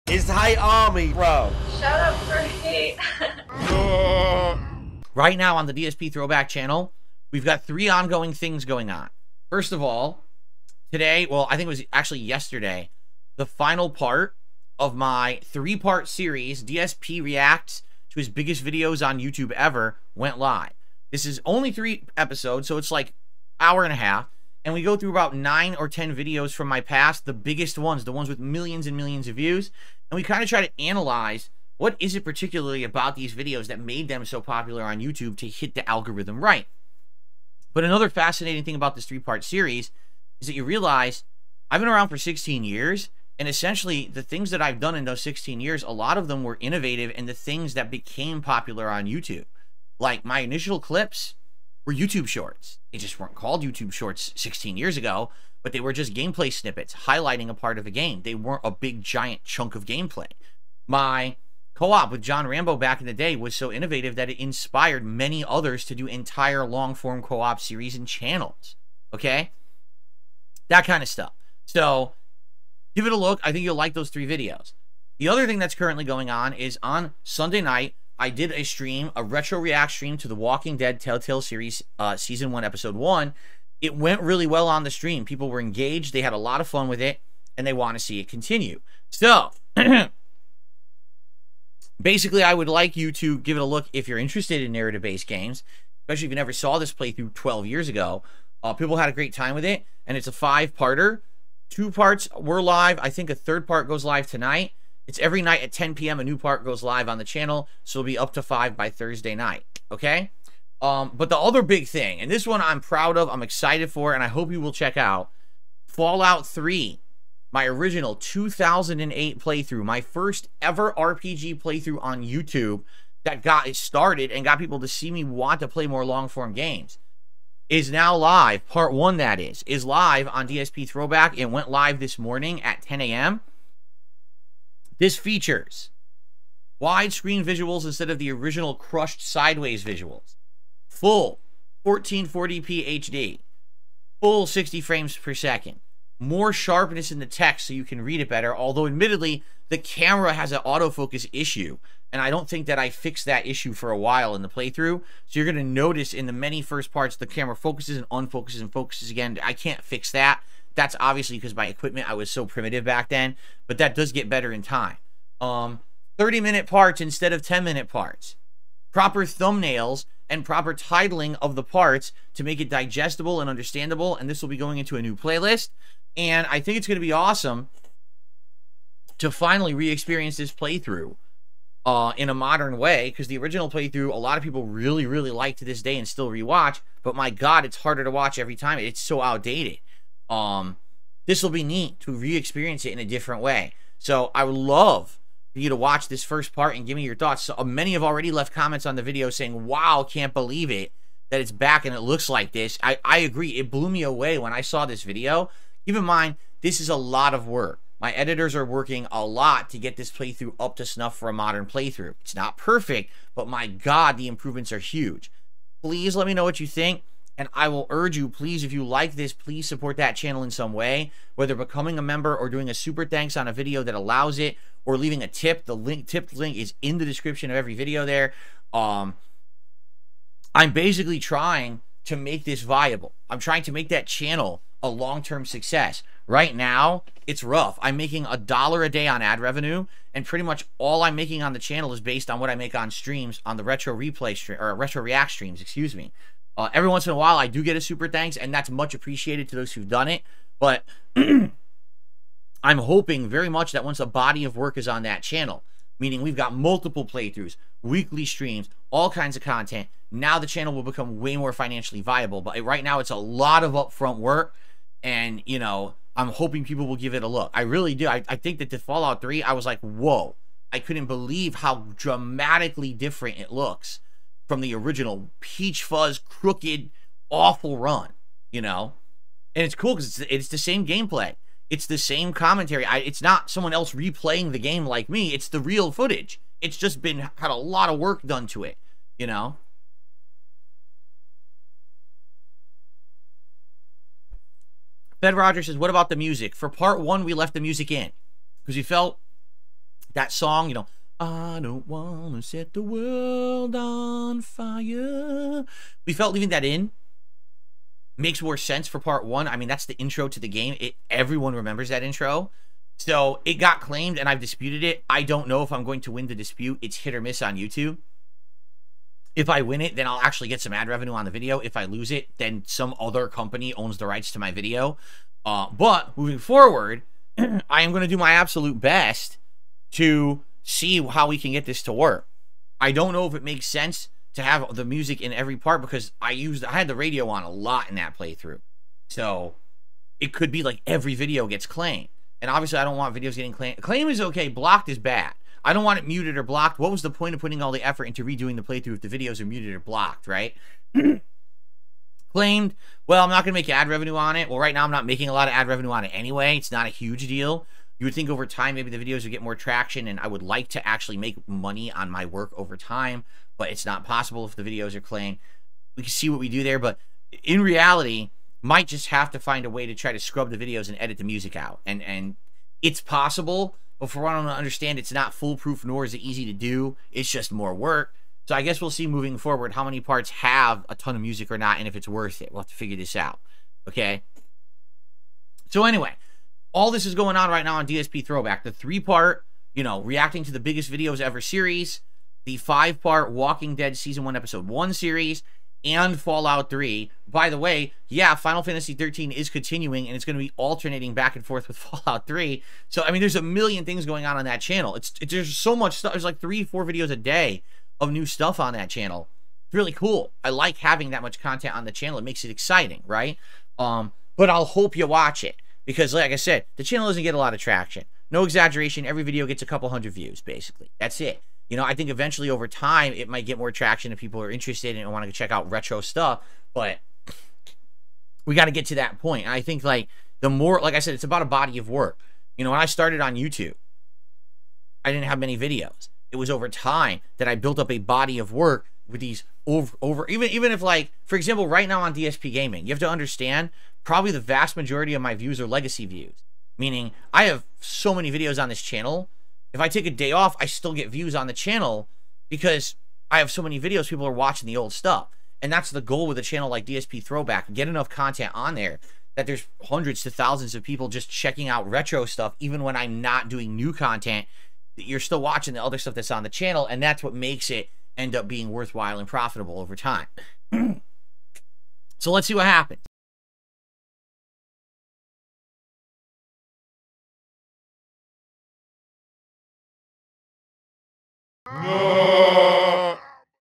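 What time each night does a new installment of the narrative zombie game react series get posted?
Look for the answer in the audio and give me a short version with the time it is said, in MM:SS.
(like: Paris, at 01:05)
10 p.m., at 01:45.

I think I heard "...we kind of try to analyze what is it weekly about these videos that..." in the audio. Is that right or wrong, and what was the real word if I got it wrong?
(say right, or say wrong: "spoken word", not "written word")
wrong: "particularly", not "weekly".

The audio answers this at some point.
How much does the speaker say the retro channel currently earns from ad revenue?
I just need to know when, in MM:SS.
03:58.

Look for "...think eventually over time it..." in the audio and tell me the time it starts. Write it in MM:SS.
07:01.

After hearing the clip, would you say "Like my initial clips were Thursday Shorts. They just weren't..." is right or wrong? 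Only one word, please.
wrong.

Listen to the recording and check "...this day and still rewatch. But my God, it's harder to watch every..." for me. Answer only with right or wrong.
right.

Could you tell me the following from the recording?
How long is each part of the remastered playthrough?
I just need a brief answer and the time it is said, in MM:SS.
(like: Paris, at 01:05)
30 minutes, at 02:46.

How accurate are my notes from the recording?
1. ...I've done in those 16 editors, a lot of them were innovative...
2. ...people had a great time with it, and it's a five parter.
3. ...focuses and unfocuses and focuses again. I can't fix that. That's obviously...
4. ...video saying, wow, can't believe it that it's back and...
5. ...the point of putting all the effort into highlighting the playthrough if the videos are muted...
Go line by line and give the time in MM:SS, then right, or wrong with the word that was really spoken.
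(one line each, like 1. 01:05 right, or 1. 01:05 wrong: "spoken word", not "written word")
1. 00:44 wrong: "years", not "editors"
2. 01:38 right
3. 02:37 right
4. 03:19 right
5. 05:47 wrong: "redoing", not "highlighting".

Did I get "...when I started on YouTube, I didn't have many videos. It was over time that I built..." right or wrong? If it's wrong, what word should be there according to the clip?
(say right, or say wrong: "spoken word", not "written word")
right.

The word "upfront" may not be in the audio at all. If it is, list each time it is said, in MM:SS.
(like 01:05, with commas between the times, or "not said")
04:23.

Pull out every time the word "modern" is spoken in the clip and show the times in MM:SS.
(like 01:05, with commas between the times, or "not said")
03:02, 03:31.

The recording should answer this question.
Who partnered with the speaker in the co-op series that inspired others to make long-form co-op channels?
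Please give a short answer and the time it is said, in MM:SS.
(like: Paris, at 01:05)
John Rambo, at 01:02.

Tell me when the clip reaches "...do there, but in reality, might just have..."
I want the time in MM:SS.
06:06.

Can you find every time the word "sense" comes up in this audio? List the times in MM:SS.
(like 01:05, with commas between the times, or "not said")
05:08, 05:33.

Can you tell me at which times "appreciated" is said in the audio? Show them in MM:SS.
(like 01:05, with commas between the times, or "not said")
04:08.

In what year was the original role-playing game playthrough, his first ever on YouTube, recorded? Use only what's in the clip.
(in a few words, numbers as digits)
2008.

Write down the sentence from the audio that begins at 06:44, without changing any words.
It's, it's There's so much stuff.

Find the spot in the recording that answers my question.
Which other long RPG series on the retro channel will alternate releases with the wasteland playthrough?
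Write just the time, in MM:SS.
06:38.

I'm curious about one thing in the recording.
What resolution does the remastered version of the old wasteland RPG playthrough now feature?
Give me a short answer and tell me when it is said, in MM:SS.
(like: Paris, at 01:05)
1440p, at 02:21.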